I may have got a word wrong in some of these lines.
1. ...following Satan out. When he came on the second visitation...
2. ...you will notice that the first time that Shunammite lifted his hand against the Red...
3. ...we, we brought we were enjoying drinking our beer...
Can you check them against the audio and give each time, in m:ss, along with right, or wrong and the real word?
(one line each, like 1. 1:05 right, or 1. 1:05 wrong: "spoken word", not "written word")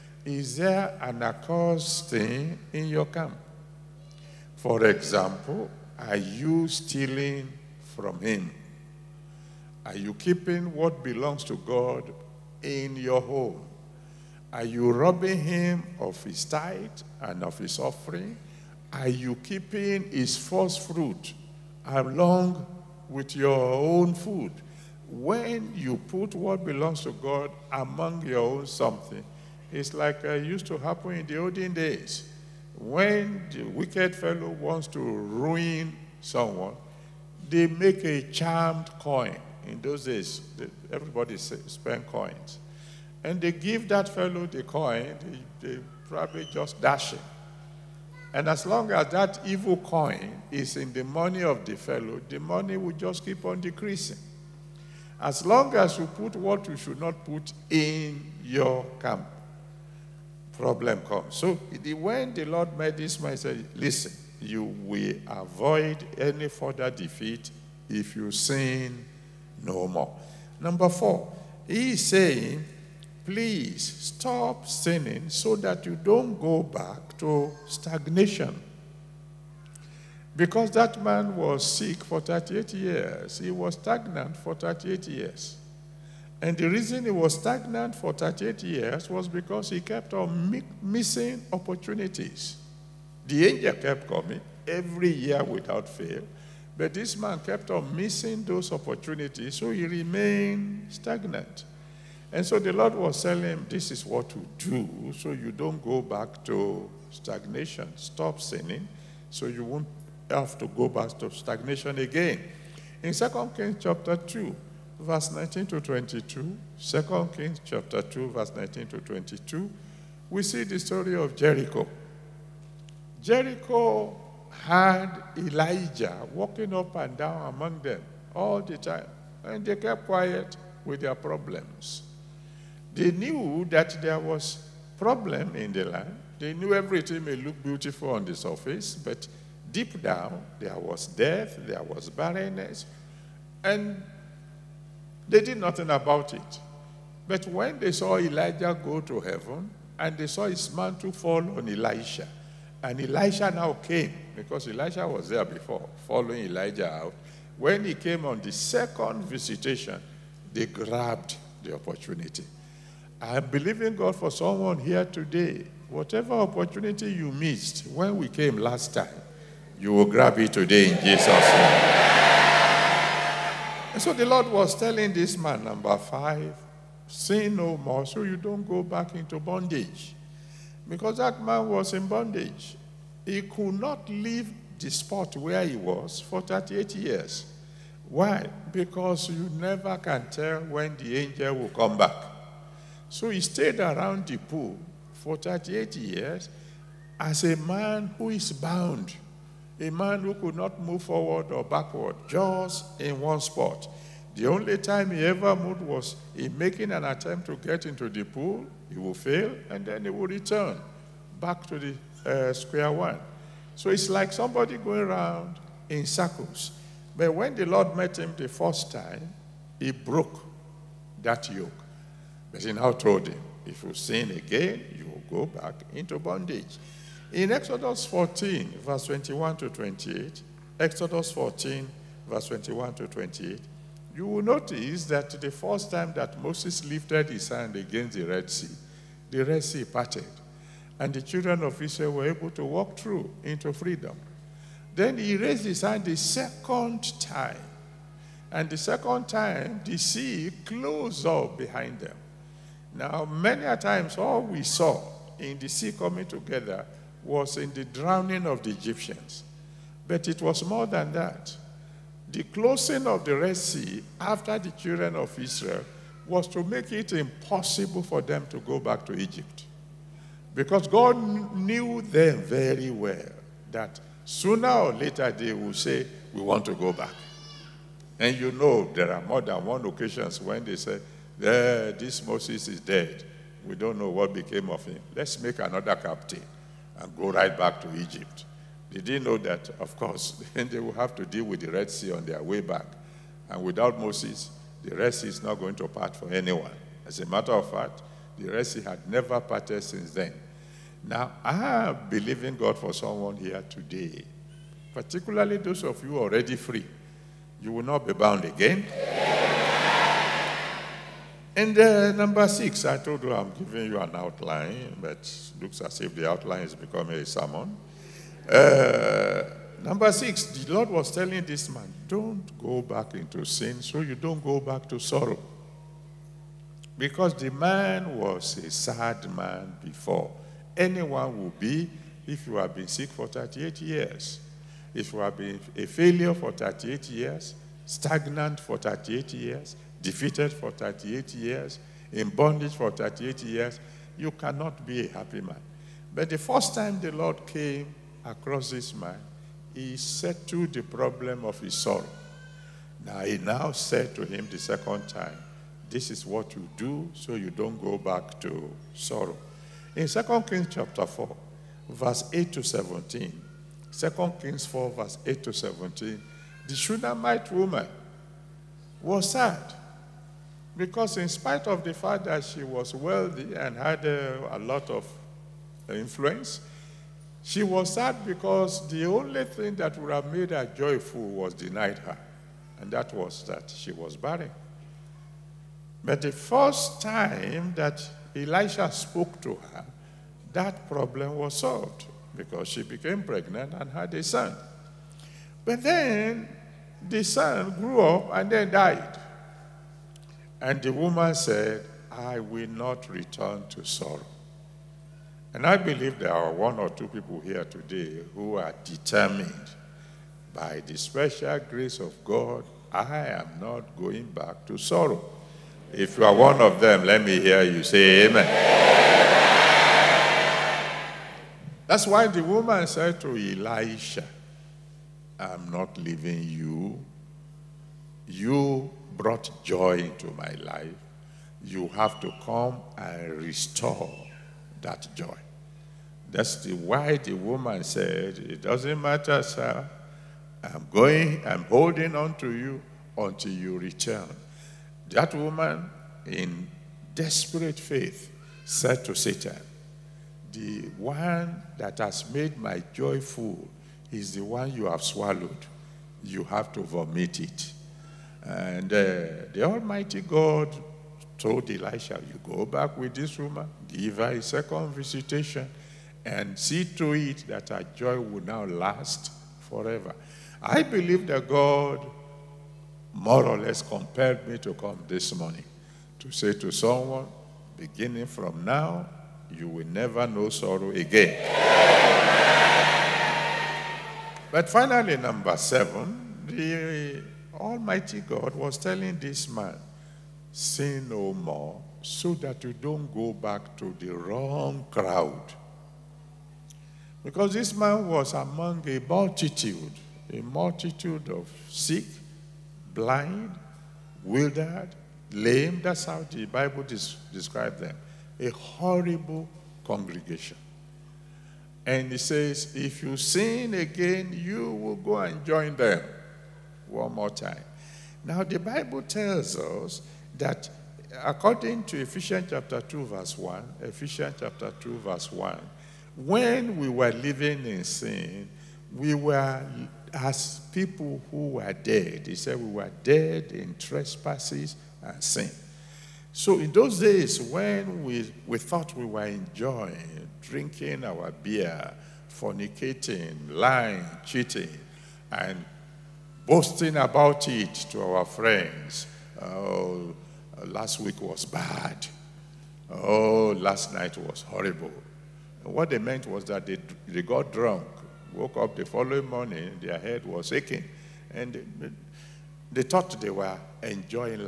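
1. 2:36 wrong: "Elijah", not "Satan"
2. 3:54 wrong: "Moses", not "Shunammite"
3. 8:58 wrong: "thought", not "brought".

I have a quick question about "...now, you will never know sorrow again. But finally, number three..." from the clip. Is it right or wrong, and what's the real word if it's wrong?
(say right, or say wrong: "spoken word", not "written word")
wrong: "seven", not "three".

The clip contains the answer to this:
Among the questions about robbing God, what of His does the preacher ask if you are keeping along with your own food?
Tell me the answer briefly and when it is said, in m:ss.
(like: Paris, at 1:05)
first fruit, at 0:20.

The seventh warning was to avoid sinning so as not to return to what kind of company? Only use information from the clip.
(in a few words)
the wrong crowd.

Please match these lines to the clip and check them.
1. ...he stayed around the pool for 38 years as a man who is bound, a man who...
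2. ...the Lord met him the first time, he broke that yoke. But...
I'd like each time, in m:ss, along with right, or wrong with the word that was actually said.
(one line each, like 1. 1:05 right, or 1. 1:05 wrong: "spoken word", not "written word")
1. 3:13 right
2. 3:37 right.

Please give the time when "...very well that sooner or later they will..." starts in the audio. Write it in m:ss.
4:32.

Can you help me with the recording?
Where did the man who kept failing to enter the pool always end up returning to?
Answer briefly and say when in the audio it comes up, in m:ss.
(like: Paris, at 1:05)
square one, at 3:32.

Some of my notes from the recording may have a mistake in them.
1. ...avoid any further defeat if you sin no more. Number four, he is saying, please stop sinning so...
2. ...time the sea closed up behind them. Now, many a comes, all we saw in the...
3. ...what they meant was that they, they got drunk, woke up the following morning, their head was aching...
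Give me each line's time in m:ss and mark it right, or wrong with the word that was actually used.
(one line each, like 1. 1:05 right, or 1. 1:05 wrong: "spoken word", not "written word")
1. 1:05 right
2. 4:09 wrong: "times", not "comes"
3. 9:15 right.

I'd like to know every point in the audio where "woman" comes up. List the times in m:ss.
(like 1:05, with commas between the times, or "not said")
6:07, 6:40, 7:02, 7:17, 7:25, 7:43.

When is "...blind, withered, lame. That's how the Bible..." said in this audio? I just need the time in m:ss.
8:22.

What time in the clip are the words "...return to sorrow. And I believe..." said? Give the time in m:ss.
6:43.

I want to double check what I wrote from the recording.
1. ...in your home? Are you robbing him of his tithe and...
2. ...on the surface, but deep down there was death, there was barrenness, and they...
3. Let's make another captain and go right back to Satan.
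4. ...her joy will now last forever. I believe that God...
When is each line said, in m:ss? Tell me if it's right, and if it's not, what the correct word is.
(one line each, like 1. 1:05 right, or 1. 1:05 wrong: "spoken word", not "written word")
1. 0:12 right
2. 2:18 right
3. 4:45 wrong: "Egypt", not "Satan"
4. 7:47 right.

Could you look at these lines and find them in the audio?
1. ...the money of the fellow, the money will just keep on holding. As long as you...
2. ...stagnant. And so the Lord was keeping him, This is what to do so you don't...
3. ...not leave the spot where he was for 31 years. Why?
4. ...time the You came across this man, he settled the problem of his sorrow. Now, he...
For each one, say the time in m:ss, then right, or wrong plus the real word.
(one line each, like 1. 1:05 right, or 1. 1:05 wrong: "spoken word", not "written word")
1. 0:50 wrong: "decreasing", not "holding"
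2. 1:40 wrong: "telling", not "keeping"
3. 3:03 wrong: "38", not "31"
4. 5:46 wrong: "Lord", not "You".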